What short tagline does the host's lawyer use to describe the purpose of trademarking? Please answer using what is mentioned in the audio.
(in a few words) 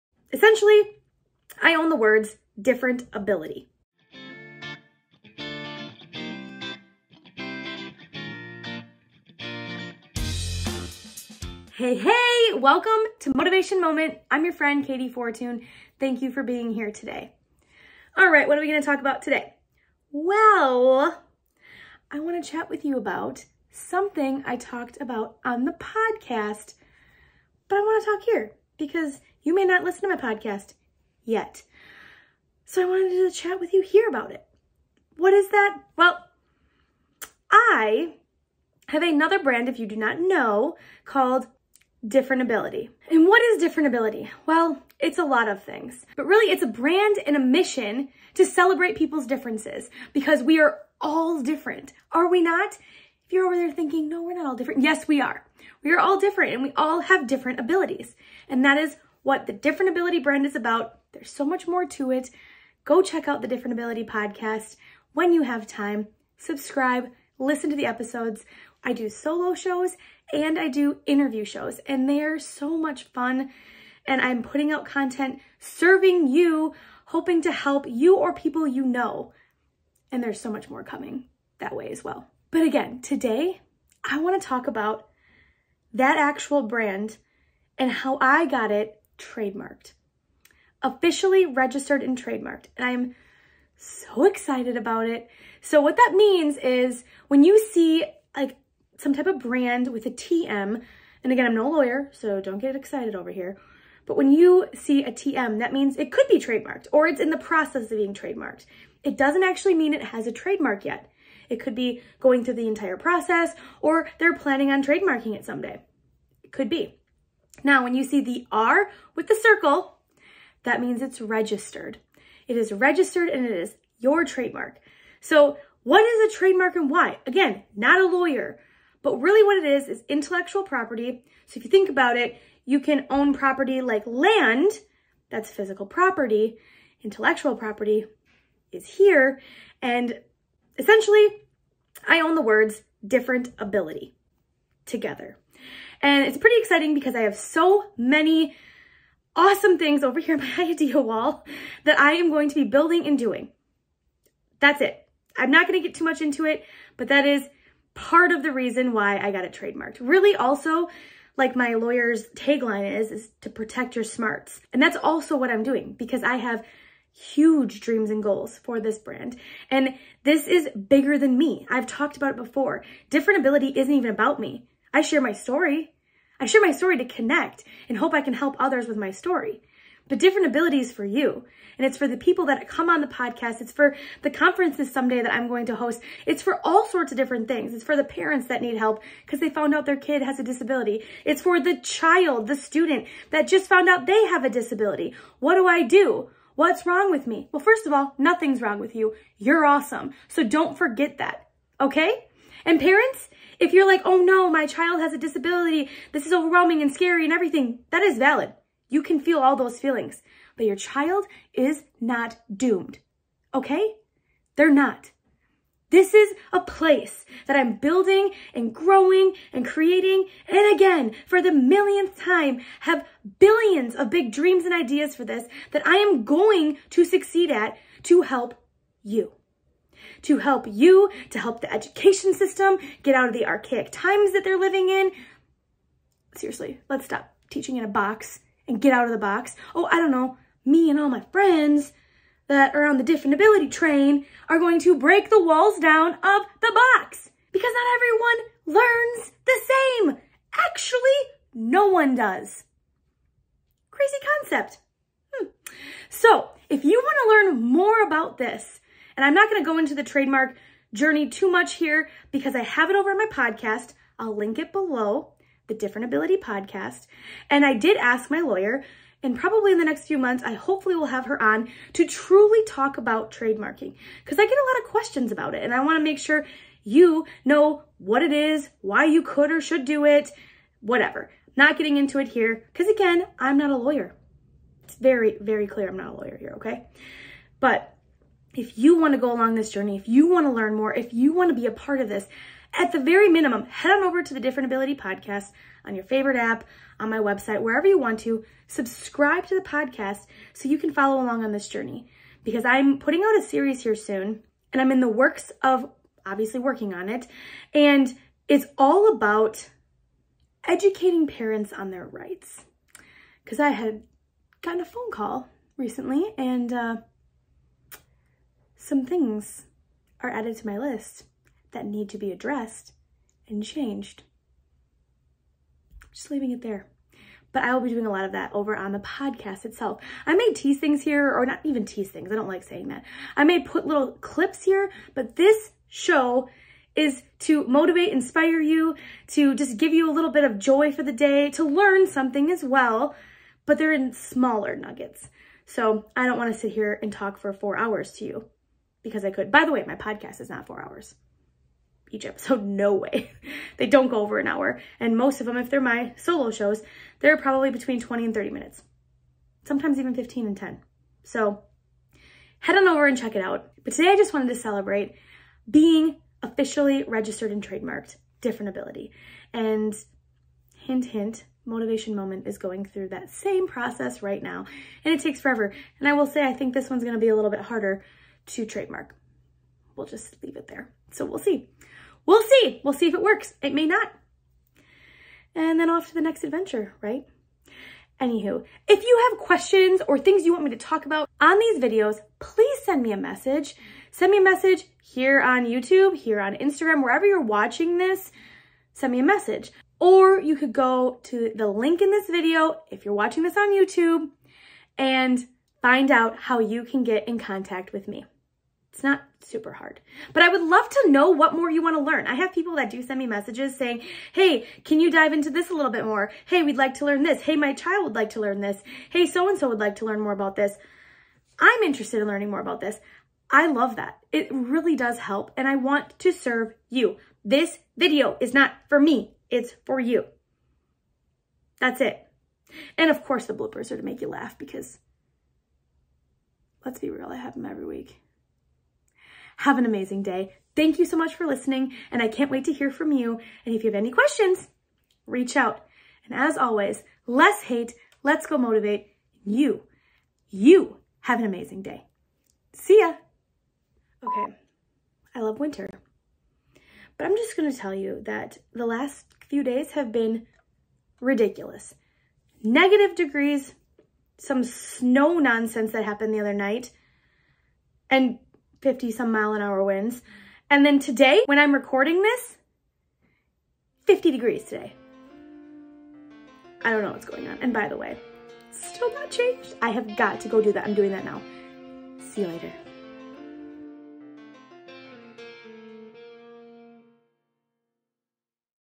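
protect your smarts.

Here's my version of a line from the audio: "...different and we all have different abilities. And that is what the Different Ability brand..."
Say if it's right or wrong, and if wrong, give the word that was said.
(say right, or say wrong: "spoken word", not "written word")
right.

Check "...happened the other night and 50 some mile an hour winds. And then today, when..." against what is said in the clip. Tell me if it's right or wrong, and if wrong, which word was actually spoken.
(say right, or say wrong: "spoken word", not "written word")
right.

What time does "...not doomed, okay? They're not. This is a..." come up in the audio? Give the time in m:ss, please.
3:31.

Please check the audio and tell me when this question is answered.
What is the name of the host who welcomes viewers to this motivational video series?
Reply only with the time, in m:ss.
0:14.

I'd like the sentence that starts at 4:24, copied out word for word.
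I'll link it below, the Different Ability Podcast.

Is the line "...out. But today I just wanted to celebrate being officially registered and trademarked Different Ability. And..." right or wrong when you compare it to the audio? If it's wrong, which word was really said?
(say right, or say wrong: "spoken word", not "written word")
right.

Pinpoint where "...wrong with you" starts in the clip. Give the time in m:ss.
3:18.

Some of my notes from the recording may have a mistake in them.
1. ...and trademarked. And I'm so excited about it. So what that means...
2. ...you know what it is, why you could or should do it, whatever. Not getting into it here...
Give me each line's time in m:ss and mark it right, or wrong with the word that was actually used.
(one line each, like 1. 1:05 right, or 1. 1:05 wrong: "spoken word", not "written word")
1. 1:32 right
2. 4:36 right.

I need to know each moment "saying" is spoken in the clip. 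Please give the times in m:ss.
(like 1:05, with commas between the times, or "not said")
5:32, 6:53.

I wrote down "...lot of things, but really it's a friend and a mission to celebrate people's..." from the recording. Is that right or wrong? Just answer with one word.
wrong.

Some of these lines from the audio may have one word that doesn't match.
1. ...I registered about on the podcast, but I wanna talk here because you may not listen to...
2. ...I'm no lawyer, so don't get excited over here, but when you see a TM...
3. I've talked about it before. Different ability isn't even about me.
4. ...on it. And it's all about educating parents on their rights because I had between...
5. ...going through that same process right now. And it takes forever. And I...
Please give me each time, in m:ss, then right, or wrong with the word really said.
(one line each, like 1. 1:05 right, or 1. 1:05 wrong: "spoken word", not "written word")
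1. 0:24 wrong: "talked", not "registered"
2. 1:41 right
3. 2:51 right
4. 5:06 wrong: "gotten", not "between"
5. 6:12 right.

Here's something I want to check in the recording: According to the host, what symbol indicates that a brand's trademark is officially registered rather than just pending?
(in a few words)
R with the circle.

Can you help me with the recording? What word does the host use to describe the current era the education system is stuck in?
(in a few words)
archaic.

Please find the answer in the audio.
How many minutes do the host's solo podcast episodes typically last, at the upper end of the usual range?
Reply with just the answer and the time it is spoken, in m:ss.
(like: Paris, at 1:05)
30, at 5:58.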